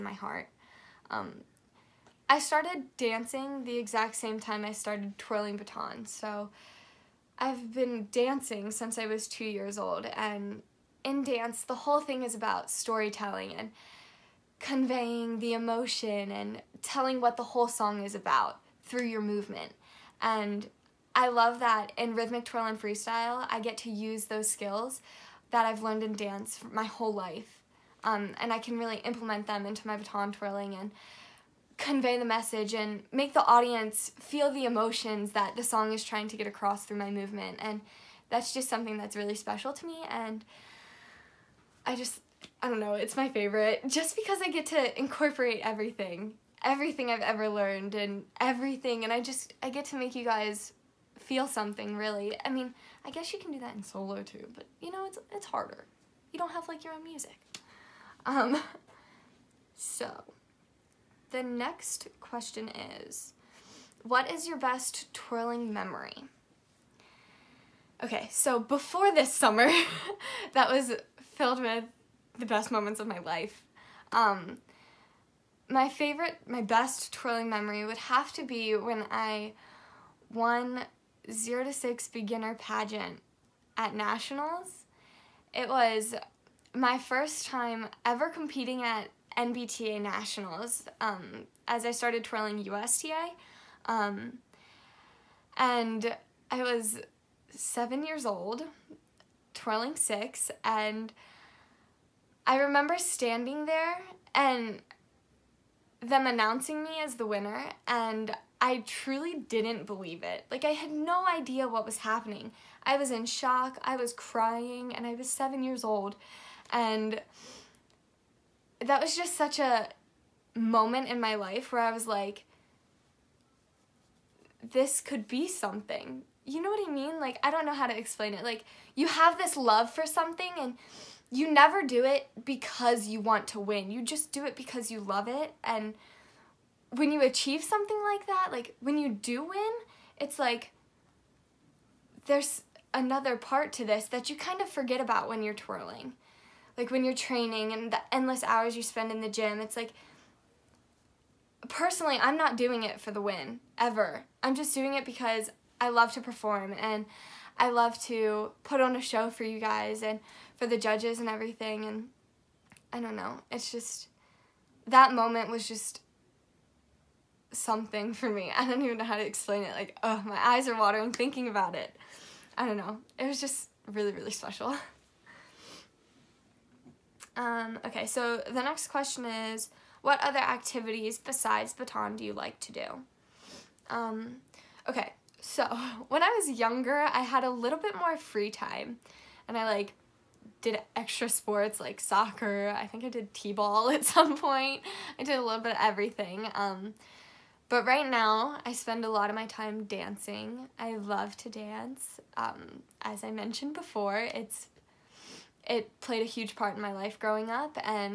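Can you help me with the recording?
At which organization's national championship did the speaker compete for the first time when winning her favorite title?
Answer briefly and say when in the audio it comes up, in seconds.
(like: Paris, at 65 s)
NBTA, at 89 s.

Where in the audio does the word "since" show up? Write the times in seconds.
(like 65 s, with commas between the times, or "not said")
8 s.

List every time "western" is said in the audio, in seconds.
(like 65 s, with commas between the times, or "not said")
not said.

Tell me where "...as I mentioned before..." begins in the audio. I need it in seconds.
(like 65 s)
203 s.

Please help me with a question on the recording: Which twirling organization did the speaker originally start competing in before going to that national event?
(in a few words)
USTA.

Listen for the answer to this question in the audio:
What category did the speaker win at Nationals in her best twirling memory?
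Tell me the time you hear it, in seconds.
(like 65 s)
81 s.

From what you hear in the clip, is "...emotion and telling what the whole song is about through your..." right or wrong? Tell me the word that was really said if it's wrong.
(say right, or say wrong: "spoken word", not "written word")
right.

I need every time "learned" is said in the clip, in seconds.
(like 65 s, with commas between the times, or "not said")
25 s, 47 s.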